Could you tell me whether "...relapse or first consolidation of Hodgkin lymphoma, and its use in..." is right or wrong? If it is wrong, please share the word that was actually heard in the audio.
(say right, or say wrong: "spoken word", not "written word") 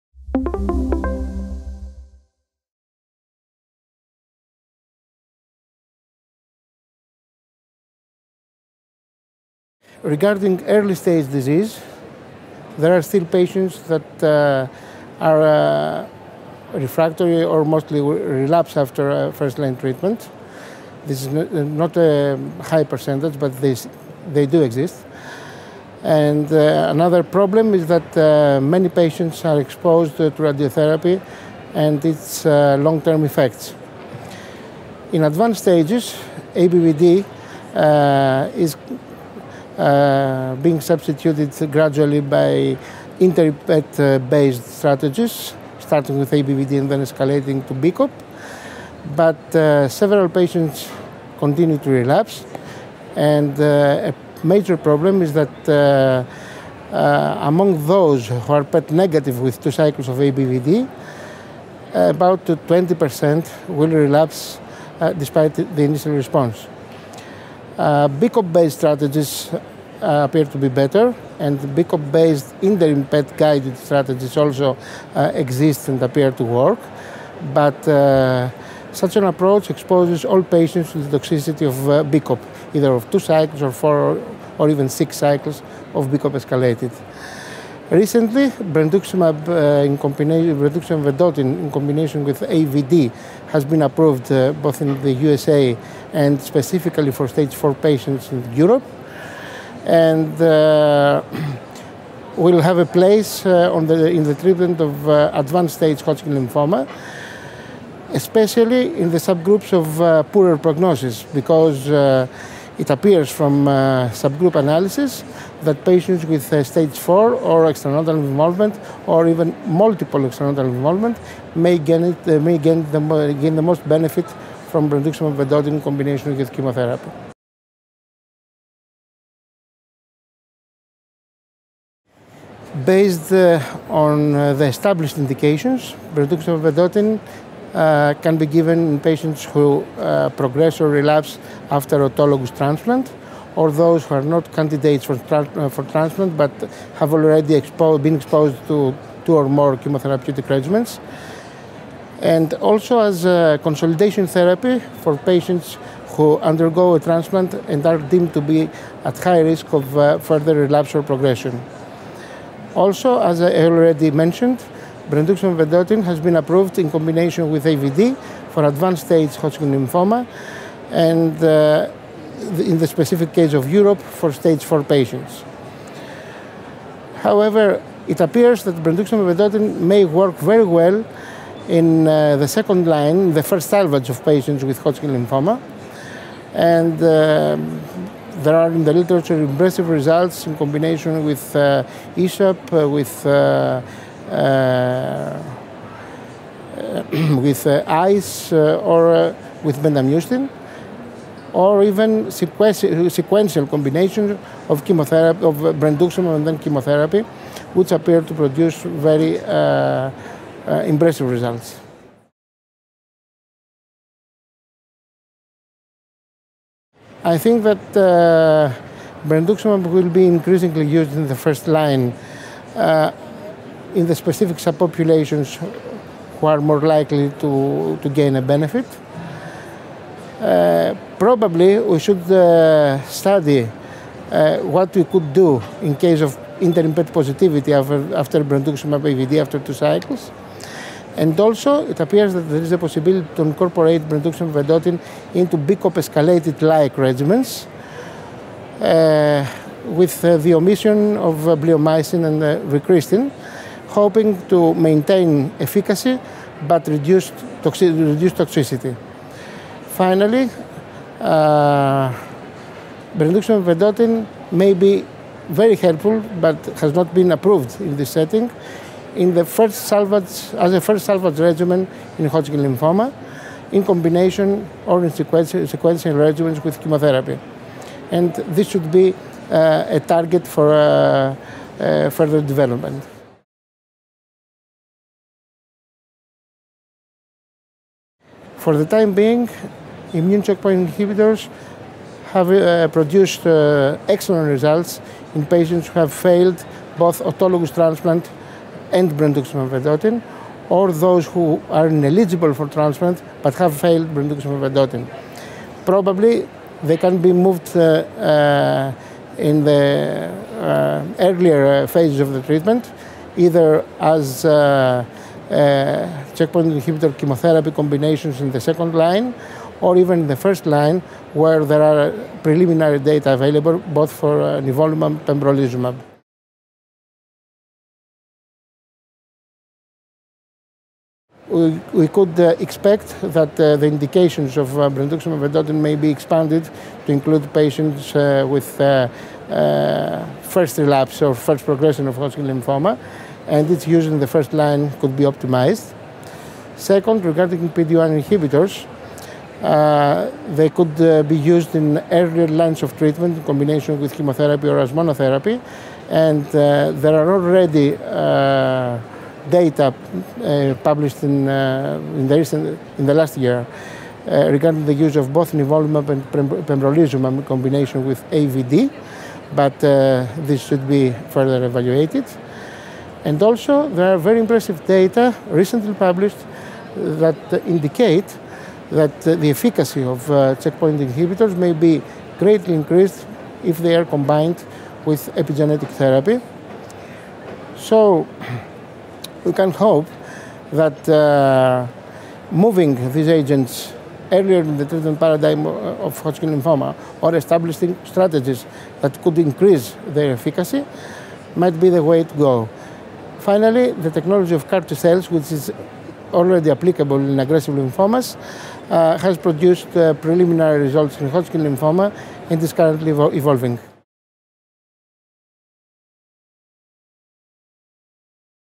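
wrong: "progression", not "consolidation".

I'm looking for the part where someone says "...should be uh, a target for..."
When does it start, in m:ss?
4:38.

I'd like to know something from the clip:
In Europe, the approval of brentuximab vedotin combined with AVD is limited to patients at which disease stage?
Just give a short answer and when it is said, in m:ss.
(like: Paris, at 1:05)
stage 4, at 1:36.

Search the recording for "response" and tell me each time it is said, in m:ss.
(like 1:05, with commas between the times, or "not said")
1:06.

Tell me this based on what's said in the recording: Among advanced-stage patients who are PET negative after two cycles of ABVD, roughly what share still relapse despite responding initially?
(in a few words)
20%.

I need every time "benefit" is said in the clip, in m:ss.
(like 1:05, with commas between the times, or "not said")
2:03, 3:48.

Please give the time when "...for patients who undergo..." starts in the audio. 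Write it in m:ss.
2:35.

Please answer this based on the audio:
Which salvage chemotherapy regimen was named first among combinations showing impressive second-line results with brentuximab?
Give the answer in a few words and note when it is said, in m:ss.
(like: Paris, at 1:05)
ESHAP, at 3:12.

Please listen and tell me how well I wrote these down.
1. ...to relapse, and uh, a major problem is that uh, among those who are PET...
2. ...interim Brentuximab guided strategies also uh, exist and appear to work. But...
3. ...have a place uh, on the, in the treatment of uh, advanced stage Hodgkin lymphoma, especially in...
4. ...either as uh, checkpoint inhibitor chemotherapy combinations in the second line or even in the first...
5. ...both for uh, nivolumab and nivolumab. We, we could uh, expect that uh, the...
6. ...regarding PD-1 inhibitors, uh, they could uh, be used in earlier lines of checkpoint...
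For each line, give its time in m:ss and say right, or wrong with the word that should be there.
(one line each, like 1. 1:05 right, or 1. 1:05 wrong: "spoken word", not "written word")
1. 0:51 right
2. 1:12 wrong: "PET", not "Brentuximab"
3. 1:42 right
4. 5:13 right
5. 5:23 wrong: "pembrolizumab", not "nivolumab"
6. 5:47 wrong: "treatment", not "checkpoint".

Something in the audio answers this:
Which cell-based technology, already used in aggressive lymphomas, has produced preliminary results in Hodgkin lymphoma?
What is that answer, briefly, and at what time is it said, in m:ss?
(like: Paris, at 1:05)
CAR T cells, at 6:44.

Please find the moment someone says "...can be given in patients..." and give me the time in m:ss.
2:18.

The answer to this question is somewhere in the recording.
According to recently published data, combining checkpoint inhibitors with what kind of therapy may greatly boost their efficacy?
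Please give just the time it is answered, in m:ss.
6:25.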